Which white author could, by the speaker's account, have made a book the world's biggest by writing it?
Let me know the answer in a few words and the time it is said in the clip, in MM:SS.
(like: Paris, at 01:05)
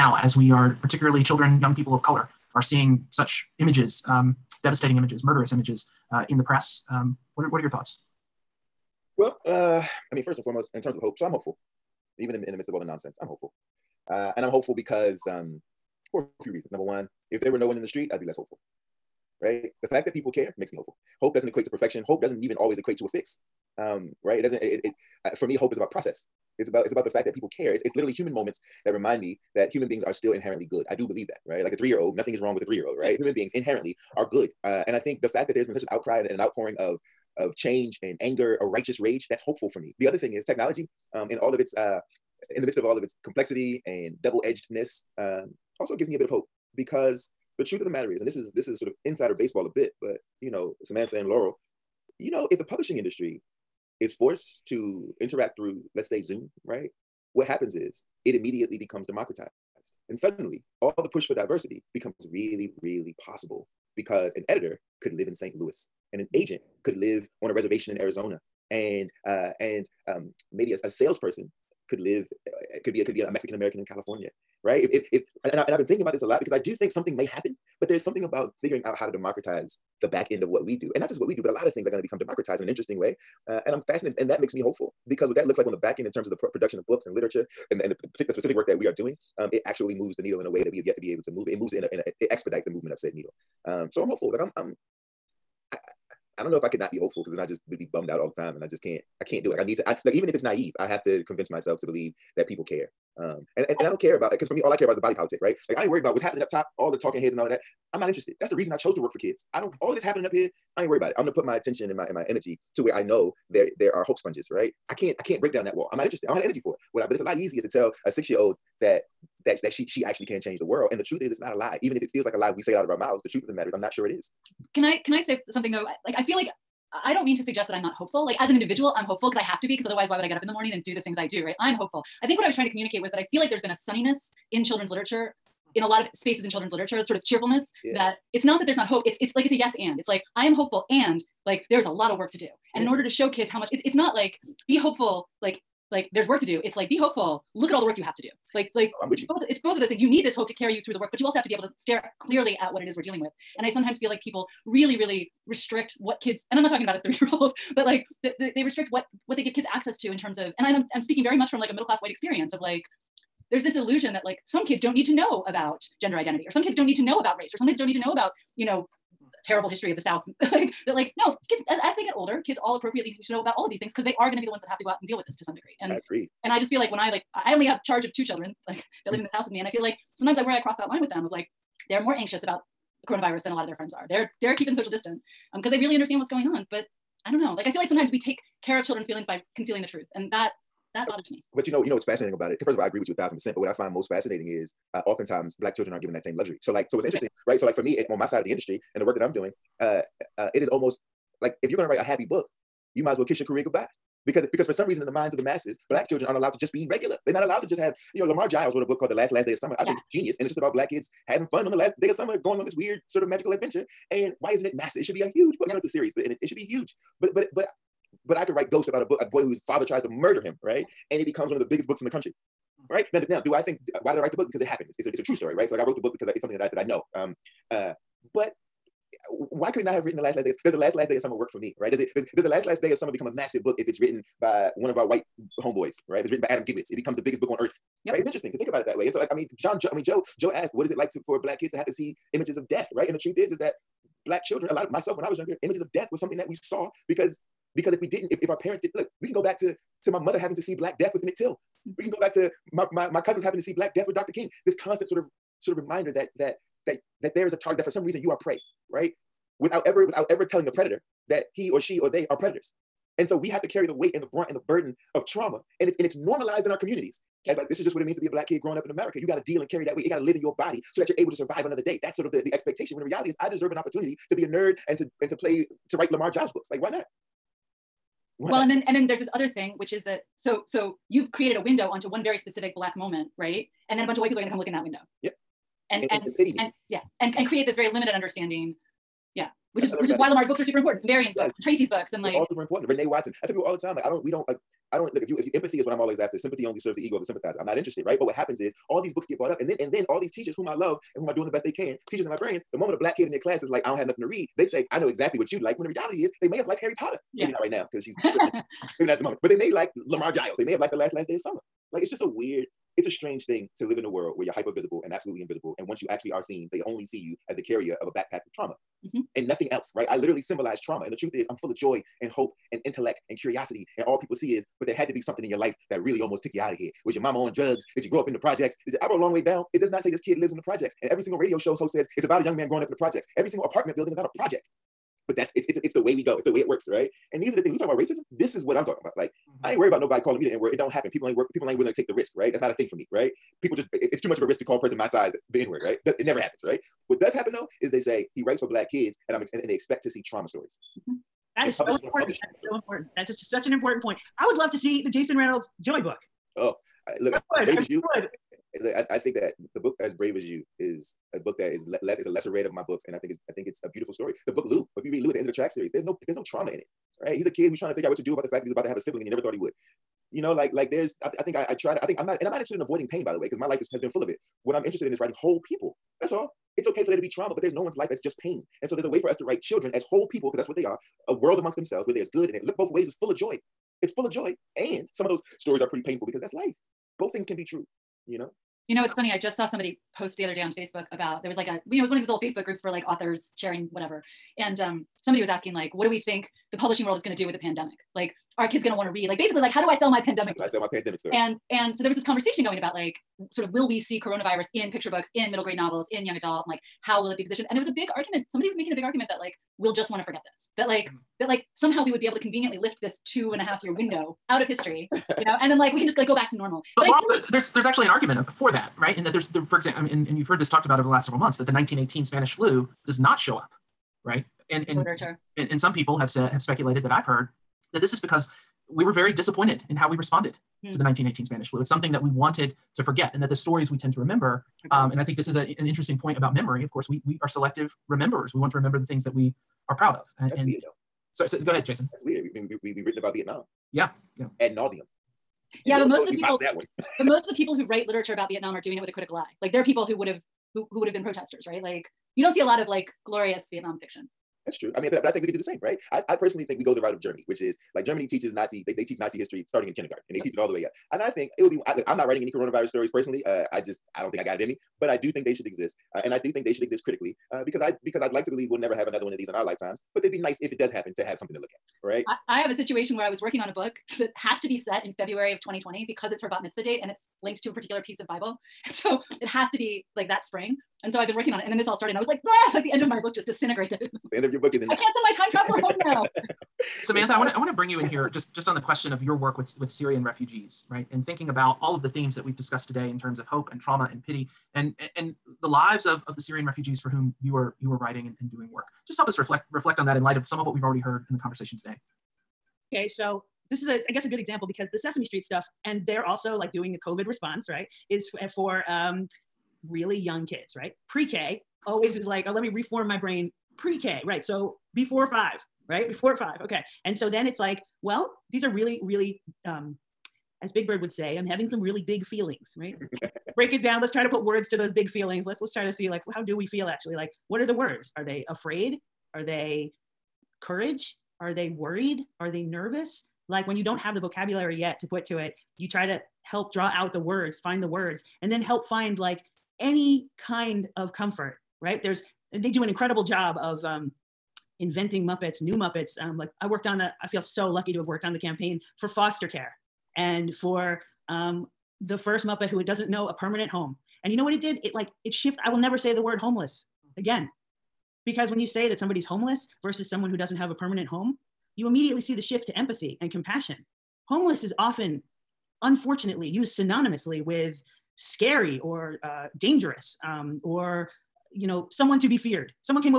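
Adam Gidwitz, at 03:56.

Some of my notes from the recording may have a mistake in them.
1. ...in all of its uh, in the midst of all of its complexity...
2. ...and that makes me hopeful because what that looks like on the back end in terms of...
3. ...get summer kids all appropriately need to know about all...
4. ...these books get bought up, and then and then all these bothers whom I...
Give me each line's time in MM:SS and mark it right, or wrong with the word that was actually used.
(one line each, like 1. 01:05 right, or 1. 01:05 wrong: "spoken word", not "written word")
1. 00:41 right
2. 01:24 right
3. 02:52 wrong: "older", not "summer"
4. 04:59 wrong: "teachers", not "bothers".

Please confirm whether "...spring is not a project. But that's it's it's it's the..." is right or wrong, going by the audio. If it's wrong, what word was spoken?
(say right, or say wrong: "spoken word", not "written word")
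wrong: "building", not "spring".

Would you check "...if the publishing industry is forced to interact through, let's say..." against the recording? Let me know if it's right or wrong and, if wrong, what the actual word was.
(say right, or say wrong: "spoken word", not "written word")
right.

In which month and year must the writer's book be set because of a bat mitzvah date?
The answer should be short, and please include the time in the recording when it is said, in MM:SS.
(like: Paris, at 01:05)
February 2020, at 07:55.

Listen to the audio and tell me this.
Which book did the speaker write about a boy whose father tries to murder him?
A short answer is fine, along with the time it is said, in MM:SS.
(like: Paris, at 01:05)
Ghost, at 03:38.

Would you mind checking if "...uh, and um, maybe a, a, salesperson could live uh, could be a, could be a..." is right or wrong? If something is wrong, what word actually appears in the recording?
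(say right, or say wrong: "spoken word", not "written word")
right.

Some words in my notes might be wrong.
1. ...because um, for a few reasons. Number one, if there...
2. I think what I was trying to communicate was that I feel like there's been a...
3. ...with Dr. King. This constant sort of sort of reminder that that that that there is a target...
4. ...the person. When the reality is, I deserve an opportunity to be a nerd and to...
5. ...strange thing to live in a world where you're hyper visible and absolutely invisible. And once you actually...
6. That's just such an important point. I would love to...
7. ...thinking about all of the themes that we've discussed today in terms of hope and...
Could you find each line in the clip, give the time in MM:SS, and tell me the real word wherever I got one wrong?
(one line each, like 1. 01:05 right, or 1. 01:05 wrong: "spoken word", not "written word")
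1. 00:14 right
2. 02:12 right
3. 04:14 right
4. 04:32 wrong: "expectation", not "person"
5. 05:13 right
6. 05:53 right
7. 08:11 right.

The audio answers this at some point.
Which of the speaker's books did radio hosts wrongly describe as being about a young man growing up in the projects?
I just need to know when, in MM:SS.
05:29.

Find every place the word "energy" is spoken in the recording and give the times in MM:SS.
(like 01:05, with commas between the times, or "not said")
01:52, 01:56.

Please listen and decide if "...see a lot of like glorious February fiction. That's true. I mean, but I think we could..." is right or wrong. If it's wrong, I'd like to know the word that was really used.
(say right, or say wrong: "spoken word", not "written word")
wrong: "Vietnam", not "February".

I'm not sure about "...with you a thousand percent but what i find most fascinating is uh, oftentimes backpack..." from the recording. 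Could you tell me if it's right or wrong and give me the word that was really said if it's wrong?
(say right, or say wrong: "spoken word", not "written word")
wrong: "black", not "backpack".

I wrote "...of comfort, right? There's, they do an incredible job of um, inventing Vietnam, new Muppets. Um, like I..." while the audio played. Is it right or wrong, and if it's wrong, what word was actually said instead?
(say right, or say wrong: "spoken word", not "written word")
wrong: "Muppets", not "Vietnam".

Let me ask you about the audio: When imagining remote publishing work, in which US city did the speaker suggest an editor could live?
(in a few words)
St. Louis.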